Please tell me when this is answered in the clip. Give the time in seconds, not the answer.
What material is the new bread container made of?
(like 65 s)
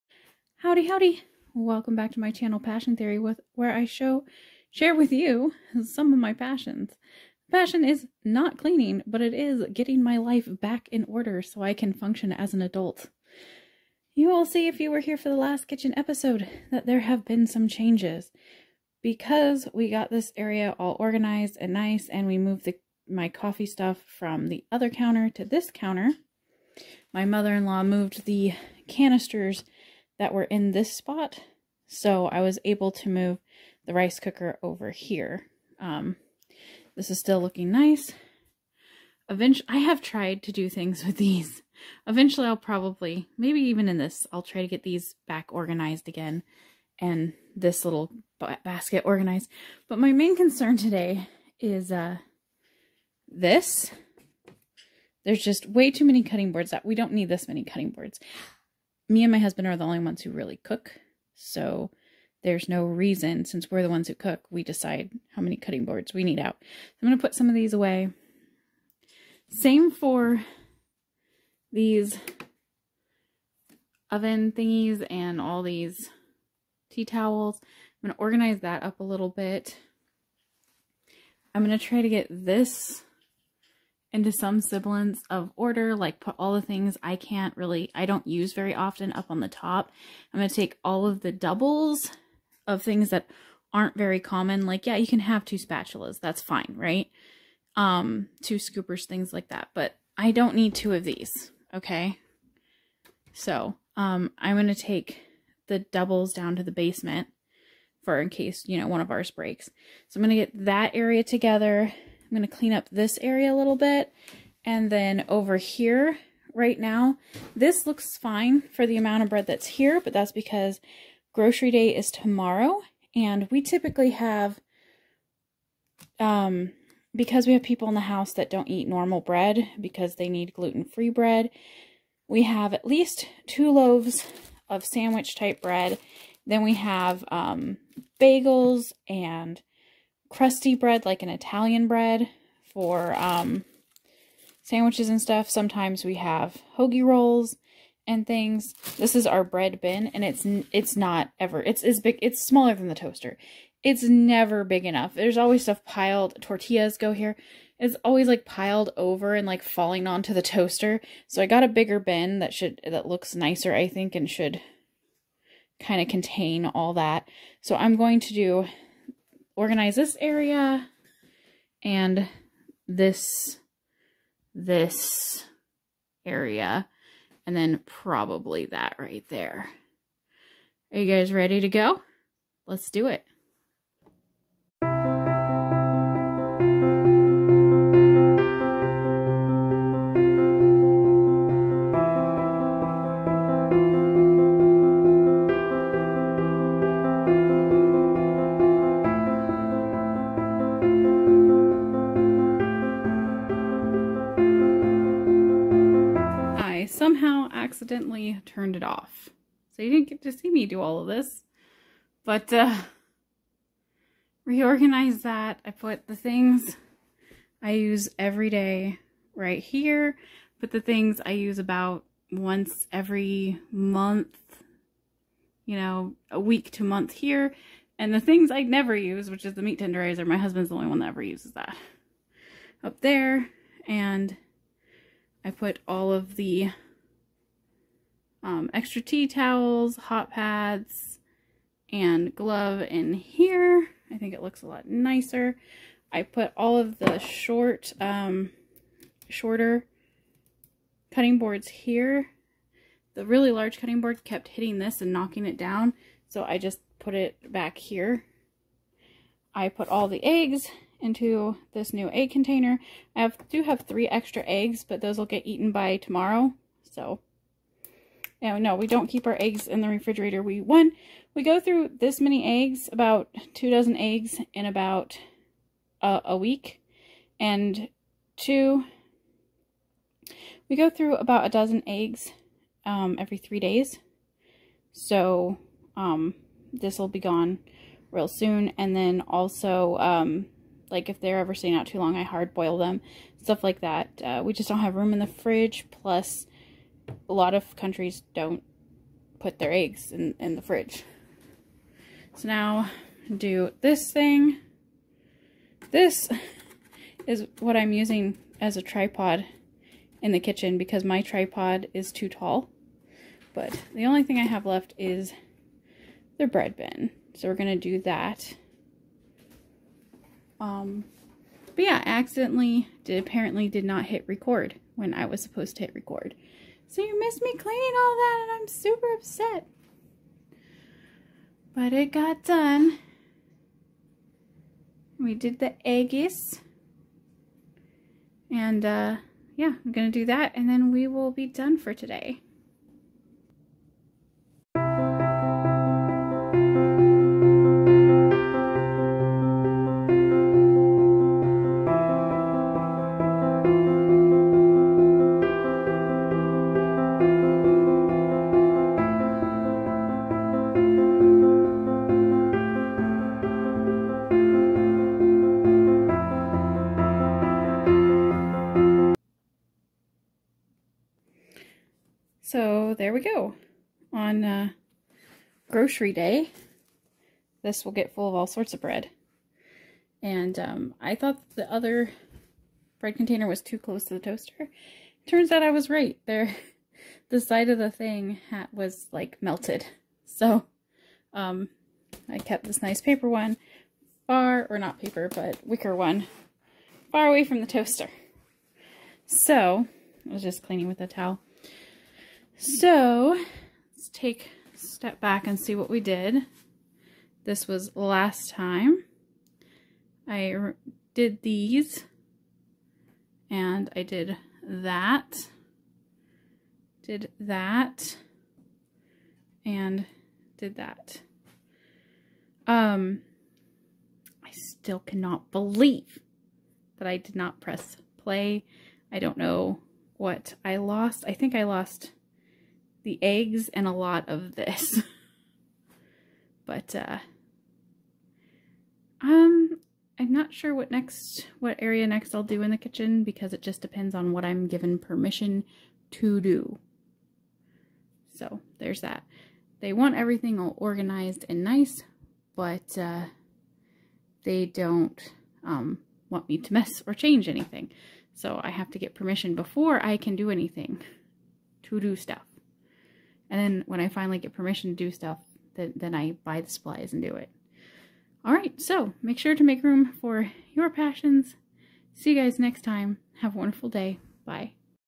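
395 s.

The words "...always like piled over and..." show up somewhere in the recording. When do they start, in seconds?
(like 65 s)
158 s.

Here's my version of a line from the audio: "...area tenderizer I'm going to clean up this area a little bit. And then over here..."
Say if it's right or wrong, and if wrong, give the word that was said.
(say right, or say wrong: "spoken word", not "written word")
wrong: "together", not "tenderizer".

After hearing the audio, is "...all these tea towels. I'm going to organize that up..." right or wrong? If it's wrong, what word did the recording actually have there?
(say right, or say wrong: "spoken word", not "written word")
right.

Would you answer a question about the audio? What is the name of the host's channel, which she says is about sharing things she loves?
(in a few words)
Passion Theory.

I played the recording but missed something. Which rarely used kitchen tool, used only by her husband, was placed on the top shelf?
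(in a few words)
meat tenderizer.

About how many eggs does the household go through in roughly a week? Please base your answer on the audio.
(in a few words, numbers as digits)
2 dozen.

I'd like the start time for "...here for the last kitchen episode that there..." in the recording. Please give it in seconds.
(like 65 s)
14 s.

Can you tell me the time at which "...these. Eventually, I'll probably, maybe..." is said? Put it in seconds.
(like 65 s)
41 s.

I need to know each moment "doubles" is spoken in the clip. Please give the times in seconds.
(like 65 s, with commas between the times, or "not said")
91 s, 105 s.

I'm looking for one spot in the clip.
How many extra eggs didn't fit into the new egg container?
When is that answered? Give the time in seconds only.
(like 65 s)
263 s.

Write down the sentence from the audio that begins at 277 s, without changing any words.
And two, we go through about a dozen eggs um, every three days.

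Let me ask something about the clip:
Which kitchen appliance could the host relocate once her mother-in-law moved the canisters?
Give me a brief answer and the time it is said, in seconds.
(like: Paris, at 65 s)
rice cooker, at 33 s.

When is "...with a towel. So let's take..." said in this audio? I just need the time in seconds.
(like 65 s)
400 s.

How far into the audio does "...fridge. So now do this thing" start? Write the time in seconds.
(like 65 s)
300 s.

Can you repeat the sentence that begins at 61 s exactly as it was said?
So there's no reason, since we're the ones who cook, we decide how many cutting boards we need out.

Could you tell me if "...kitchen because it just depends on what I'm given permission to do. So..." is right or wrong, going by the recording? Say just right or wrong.
right.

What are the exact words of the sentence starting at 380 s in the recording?
And um, I thought the other bread container was too close to the toaster.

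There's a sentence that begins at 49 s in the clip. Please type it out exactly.
But my main concern today is uh, this.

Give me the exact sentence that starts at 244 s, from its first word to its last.
I think it looks a lot nicer.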